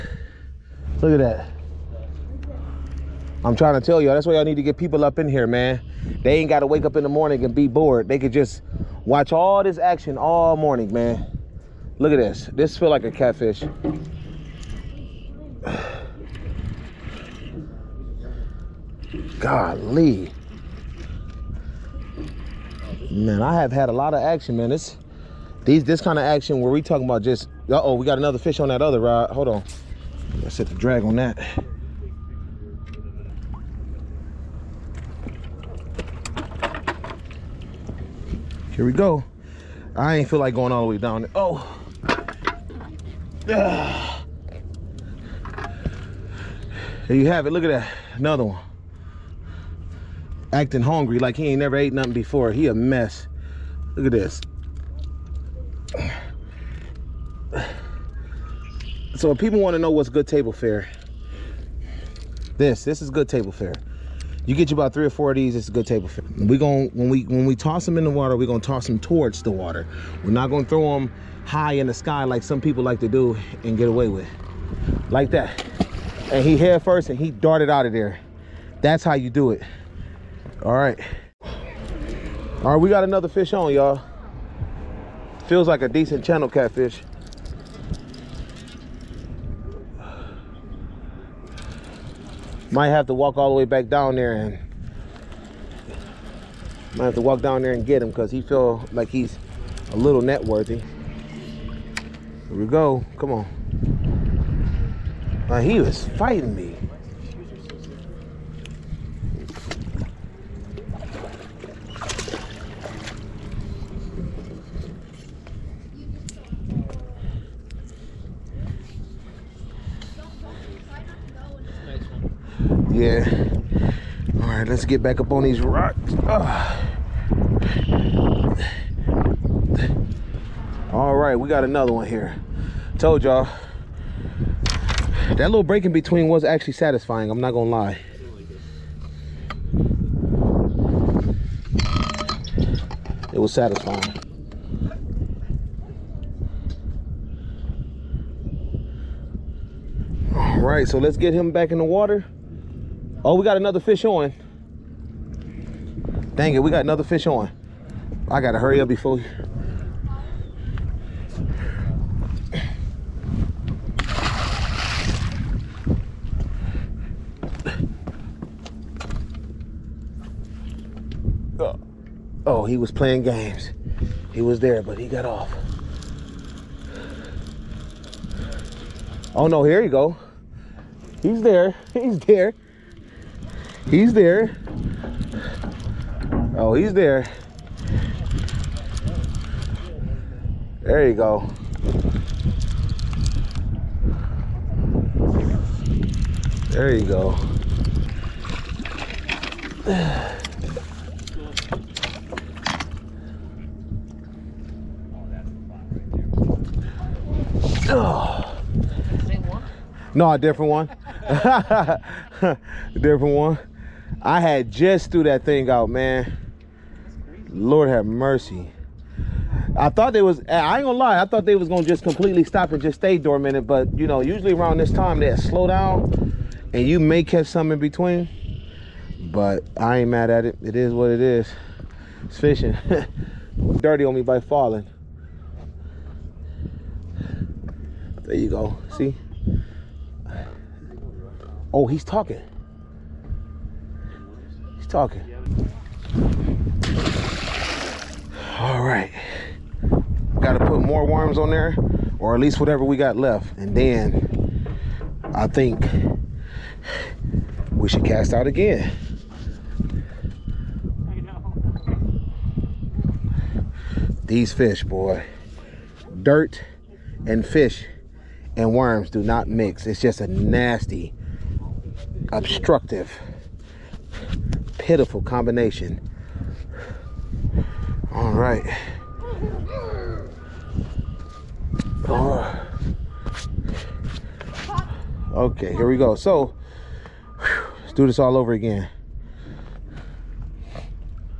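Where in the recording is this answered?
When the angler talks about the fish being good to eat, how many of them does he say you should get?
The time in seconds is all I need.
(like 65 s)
64 s.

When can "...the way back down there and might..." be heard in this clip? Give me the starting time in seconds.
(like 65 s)
93 s.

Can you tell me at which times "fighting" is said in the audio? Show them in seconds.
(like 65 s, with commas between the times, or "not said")
106 s.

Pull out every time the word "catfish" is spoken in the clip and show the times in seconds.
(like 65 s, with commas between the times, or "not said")
13 s, 86 s.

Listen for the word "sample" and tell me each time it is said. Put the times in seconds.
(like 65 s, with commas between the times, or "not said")
not said.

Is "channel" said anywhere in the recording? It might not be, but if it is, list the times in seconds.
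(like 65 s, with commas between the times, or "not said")
86 s.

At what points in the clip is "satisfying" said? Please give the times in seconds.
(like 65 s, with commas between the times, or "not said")
136 s, 143 s.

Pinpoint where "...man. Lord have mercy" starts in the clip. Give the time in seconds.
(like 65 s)
215 s.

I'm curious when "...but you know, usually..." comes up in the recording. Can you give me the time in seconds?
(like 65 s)
223 s.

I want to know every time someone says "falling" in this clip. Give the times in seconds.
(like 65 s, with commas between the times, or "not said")
234 s.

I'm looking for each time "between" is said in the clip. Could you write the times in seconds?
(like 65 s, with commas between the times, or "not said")
135 s, 227 s.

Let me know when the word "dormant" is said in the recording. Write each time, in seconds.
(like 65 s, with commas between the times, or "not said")
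223 s.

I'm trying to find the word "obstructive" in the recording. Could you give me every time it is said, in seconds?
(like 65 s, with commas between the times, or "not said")
272 s.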